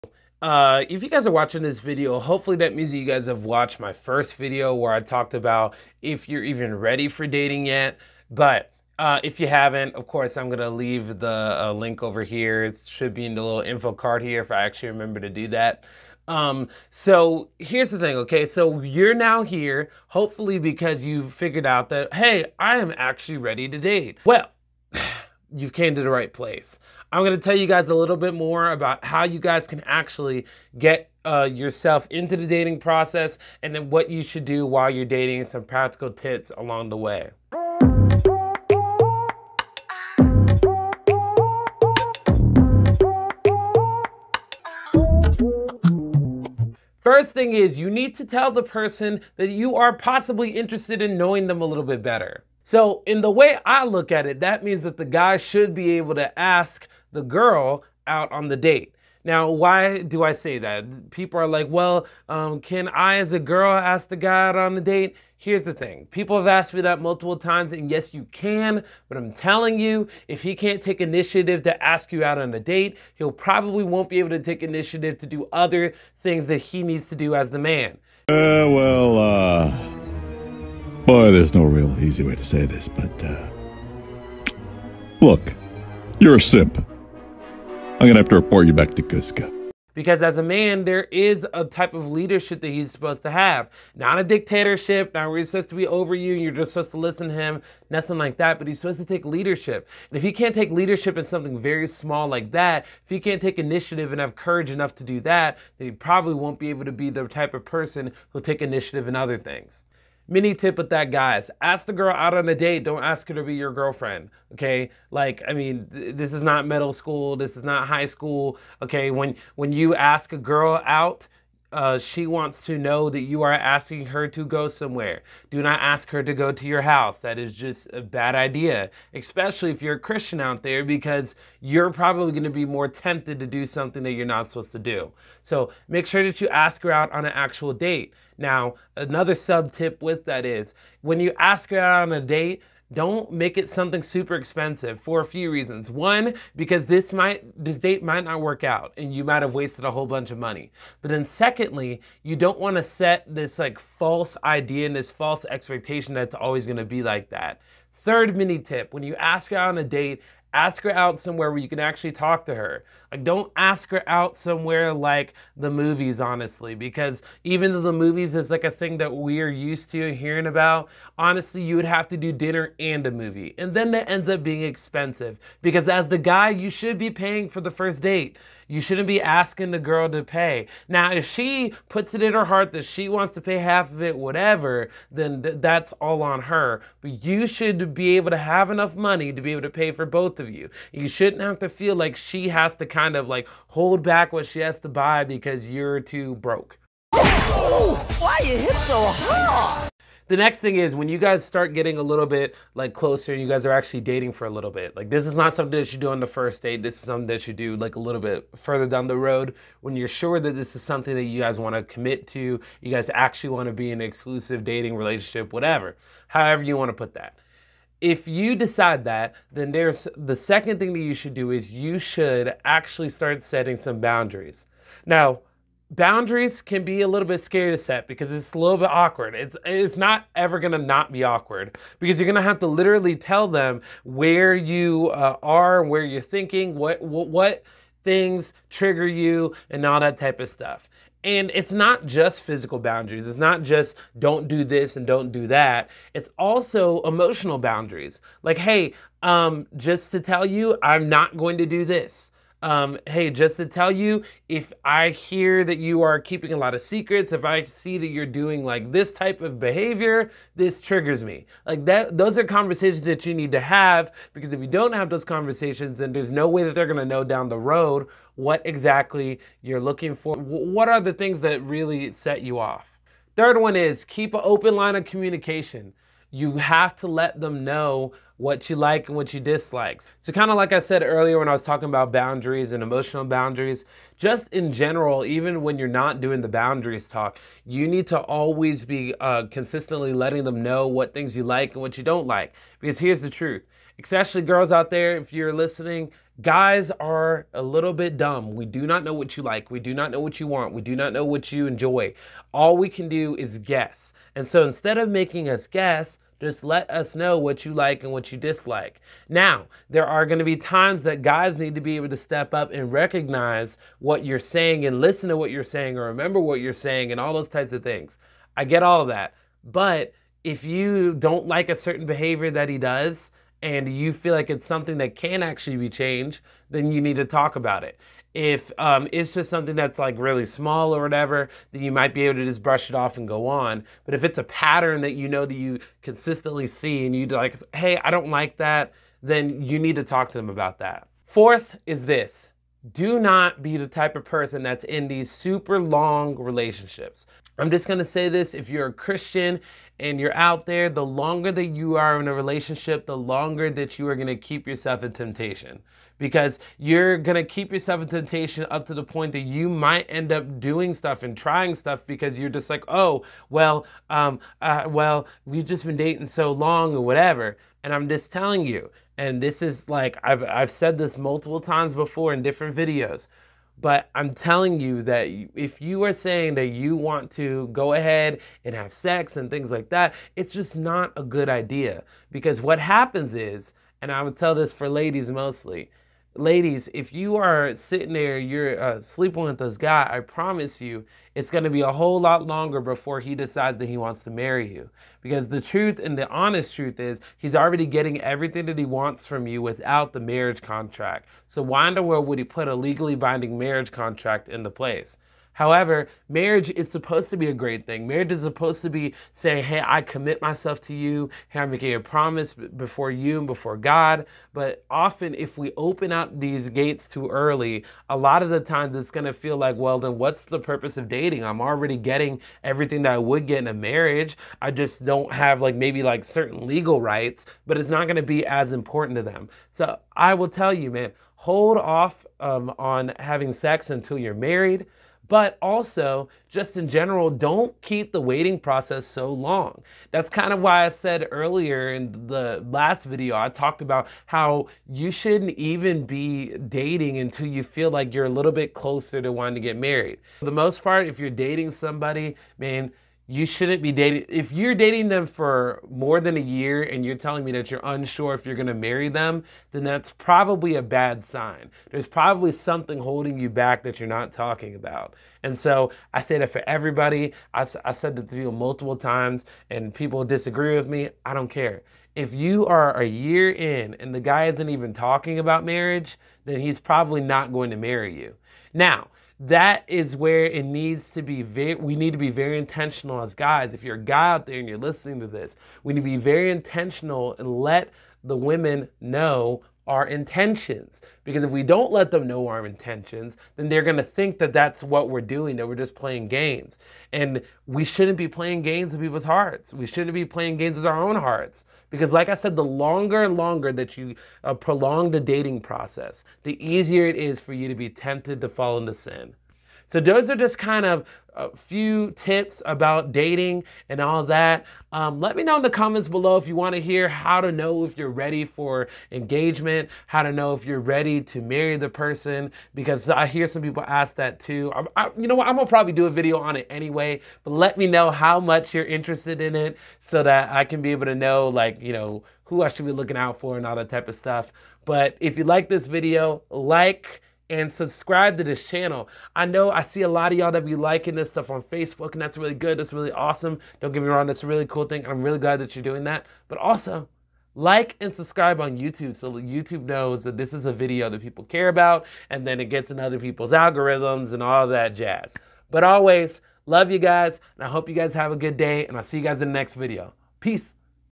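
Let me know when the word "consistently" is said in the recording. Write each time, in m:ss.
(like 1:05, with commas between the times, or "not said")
4:49, 5:36.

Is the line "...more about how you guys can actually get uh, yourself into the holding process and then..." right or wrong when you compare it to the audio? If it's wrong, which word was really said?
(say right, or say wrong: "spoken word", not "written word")
wrong: "dating", not "holding".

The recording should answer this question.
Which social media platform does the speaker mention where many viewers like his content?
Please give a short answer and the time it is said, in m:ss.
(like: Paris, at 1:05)
Facebook, at 9:01.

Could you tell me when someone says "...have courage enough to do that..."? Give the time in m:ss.
1:44.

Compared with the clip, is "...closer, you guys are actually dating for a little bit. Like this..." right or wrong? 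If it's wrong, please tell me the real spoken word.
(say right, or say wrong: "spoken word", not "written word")
right.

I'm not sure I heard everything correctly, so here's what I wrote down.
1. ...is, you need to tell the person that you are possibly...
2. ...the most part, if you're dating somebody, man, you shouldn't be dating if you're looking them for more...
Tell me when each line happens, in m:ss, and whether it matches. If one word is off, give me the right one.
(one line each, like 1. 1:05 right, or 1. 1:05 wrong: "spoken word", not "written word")
1. 0:47 right
2. 7:30 wrong: "dating", not "looking".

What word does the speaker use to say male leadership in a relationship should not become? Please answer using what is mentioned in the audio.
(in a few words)
A dictatorship.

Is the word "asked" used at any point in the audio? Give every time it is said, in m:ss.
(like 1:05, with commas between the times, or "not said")
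1:06.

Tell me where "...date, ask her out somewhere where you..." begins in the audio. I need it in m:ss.
2:39.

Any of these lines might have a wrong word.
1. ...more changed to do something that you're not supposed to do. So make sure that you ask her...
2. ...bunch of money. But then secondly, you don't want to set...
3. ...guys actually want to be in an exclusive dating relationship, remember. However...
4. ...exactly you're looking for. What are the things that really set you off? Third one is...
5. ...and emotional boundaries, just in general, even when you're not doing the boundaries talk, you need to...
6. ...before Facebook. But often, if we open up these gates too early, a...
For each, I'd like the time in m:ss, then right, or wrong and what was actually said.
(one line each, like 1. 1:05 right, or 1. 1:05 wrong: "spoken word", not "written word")
1. 2:12 wrong: "tempted", not "changed"
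2. 2:30 right
3. 3:32 wrong: "whatever", not "remember"
4. 4:28 right
5. 4:42 right
6. 6:53 wrong: "God", not "Facebook".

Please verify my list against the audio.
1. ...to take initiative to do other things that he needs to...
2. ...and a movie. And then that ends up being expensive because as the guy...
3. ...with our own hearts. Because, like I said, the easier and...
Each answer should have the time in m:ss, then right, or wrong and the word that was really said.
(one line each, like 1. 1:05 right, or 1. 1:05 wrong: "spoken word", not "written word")
1. 1:14 right
2. 2:52 right
3. 8:20 wrong: "longer", not "easier".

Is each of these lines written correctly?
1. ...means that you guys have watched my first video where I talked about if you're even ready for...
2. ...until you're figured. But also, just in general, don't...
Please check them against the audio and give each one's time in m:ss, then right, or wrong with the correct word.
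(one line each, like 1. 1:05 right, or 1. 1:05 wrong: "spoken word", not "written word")
1. 0:02 right
2. 7:13 wrong: "married", not "figured".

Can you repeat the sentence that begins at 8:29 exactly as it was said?
So those are just kind of a few tips about dating and all that.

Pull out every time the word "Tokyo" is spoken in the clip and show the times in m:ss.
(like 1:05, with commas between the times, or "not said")
not said.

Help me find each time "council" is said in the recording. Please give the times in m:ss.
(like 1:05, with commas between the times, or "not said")
not said.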